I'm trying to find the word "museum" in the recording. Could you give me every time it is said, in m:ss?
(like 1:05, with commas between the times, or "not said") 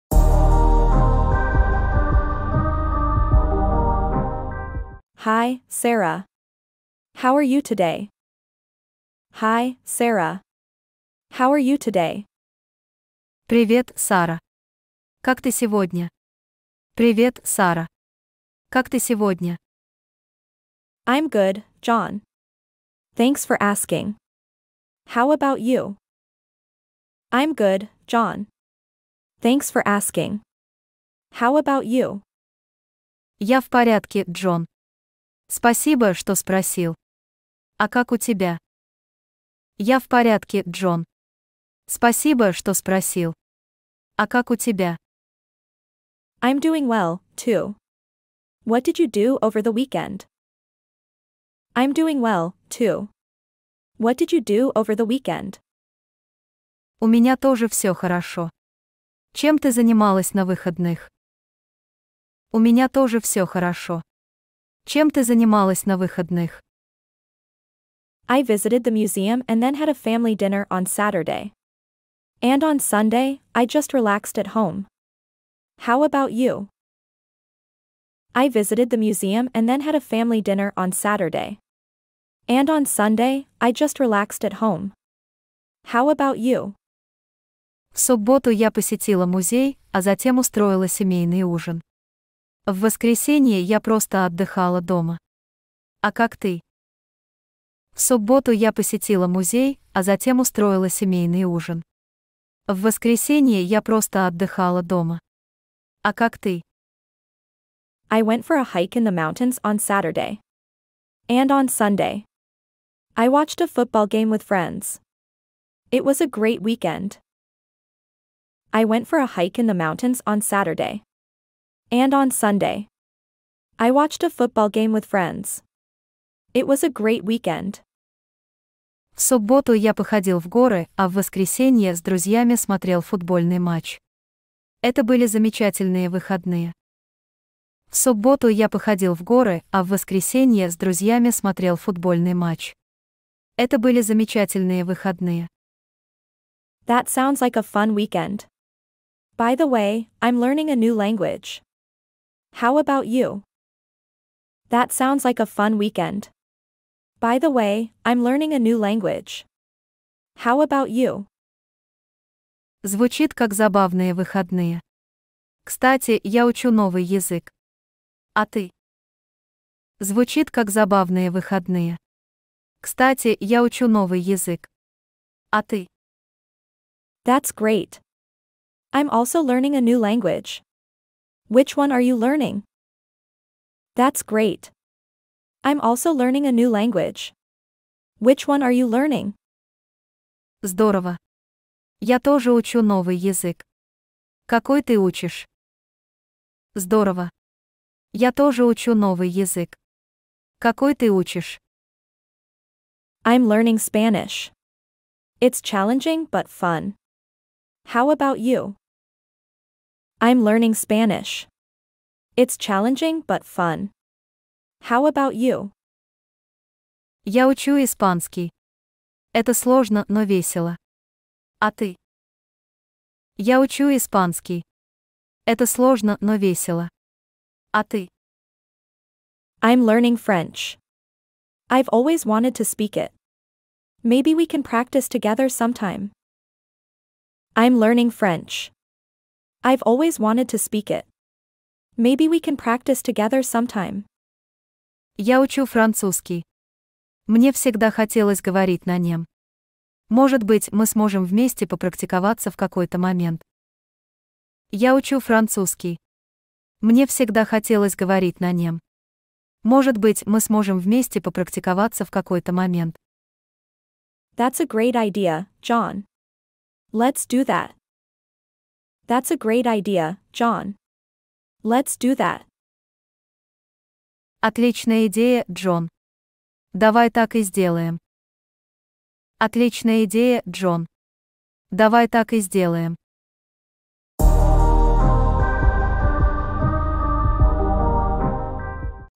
1:08, 1:18.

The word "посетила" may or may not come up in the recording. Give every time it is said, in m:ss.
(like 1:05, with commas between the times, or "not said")
1:28, 1:38.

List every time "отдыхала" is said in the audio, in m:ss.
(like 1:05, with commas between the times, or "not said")
1:34, 1:44.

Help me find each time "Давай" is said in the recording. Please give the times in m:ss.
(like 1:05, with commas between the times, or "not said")
4:36, 4:41.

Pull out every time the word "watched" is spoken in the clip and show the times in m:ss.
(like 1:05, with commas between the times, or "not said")
1:53, 2:03.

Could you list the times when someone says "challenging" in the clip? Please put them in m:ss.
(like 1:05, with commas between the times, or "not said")
3:25, 3:32.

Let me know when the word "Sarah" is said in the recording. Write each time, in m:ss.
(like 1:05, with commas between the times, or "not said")
0:05, 0:09.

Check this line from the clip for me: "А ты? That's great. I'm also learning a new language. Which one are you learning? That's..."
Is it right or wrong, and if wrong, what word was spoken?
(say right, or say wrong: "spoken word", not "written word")
right.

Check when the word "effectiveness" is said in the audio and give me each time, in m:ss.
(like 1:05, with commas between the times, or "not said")
not said.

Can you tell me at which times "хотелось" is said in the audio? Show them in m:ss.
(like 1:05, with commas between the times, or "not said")
4:07, 4:17.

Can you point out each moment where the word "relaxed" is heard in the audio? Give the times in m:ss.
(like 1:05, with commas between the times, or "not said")
1:13, 1:23.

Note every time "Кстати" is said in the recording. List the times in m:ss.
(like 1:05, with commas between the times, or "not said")
2:45, 2:52.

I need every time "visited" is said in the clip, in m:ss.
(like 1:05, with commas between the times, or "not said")
1:08, 1:18.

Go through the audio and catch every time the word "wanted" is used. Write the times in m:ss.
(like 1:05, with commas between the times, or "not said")
3:52, 4:00.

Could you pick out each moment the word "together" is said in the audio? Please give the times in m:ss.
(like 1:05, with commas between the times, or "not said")
3:55, 4:03.